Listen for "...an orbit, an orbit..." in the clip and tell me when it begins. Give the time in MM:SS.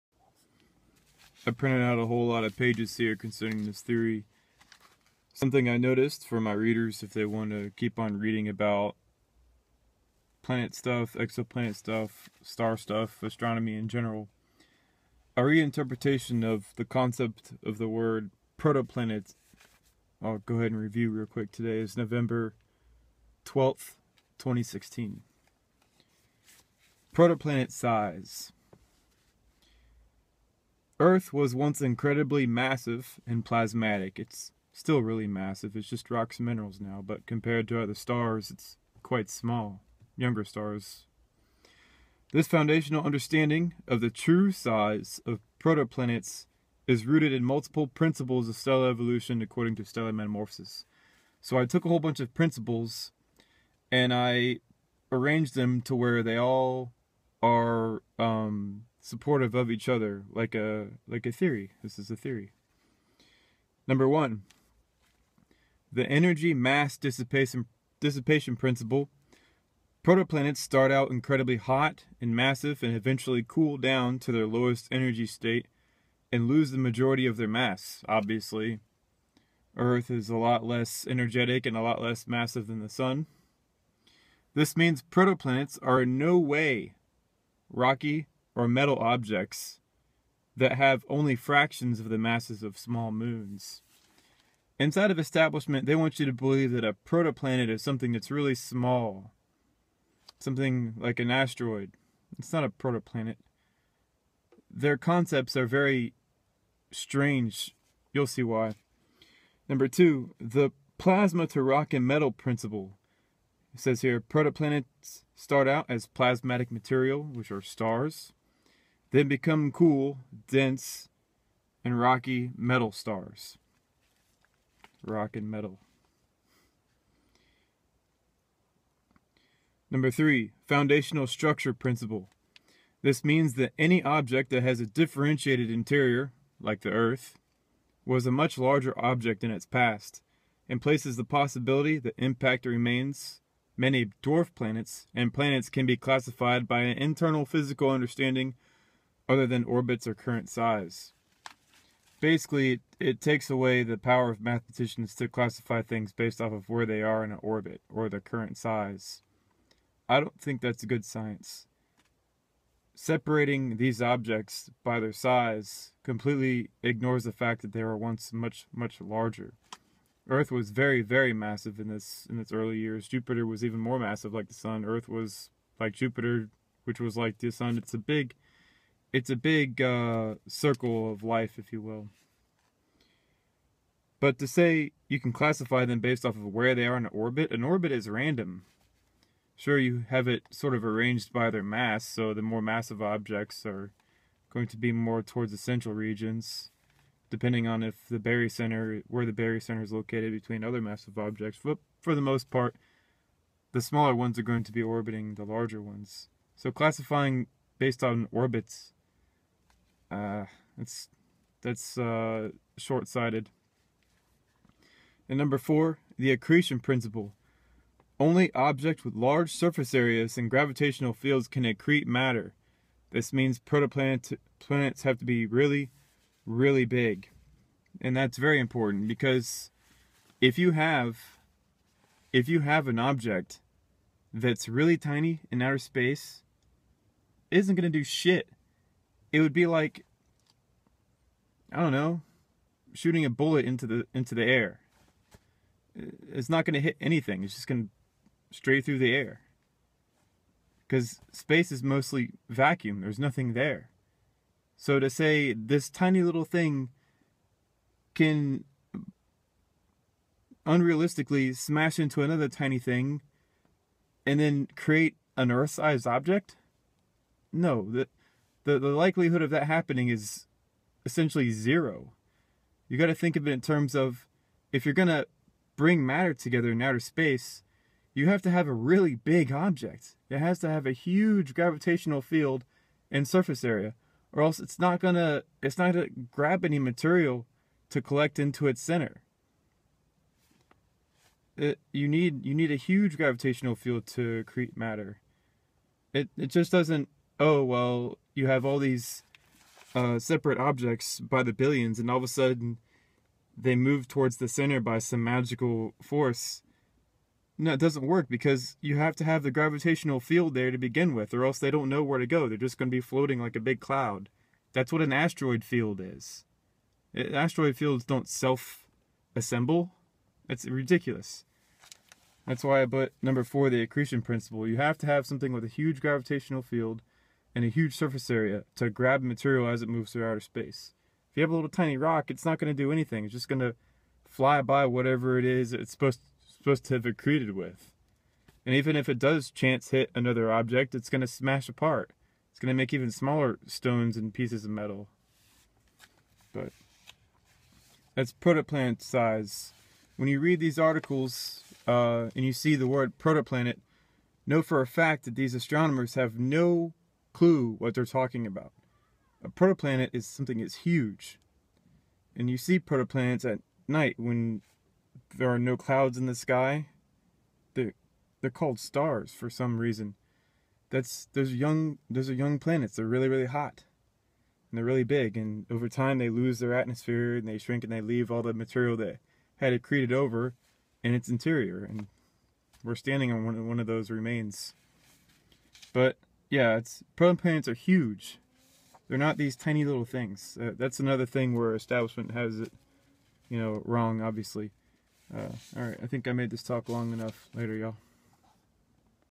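03:07.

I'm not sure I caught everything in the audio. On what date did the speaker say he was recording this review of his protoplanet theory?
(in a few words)
November 12th, 2016.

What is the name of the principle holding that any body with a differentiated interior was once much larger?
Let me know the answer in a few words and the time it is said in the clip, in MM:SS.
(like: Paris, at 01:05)
Foundational structure principle, at 02:10.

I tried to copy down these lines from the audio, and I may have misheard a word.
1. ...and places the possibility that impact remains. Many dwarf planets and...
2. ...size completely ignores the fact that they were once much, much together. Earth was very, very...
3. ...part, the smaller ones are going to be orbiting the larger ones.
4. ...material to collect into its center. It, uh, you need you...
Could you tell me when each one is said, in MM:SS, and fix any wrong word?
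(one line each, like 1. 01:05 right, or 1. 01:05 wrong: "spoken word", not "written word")
1. 02:20 right
2. 02:45 wrong: "larger", not "together"
3. 03:22 right
4. 04:46 right.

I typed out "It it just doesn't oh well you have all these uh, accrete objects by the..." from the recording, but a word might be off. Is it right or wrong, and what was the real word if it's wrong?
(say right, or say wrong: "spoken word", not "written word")
wrong: "separate", not "accrete".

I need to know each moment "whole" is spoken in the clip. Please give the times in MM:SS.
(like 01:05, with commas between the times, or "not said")
00:02, 00:51.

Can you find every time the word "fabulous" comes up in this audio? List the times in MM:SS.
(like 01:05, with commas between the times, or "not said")
not said.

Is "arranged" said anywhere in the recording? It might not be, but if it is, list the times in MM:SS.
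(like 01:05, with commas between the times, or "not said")
00:55, 03:10.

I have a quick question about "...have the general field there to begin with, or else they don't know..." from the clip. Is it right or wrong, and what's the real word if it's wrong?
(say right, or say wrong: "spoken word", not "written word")
wrong: "gravitational", not "general".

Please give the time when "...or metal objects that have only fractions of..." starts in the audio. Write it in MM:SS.
01:28.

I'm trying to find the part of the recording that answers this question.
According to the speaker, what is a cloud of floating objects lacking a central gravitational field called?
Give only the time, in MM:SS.
05:15.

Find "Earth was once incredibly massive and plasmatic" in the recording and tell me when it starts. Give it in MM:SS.
00:31.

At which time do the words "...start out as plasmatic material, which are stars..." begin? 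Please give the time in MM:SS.
01:55.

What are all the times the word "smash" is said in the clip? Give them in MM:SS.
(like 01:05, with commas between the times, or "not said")
04:21, 05:41.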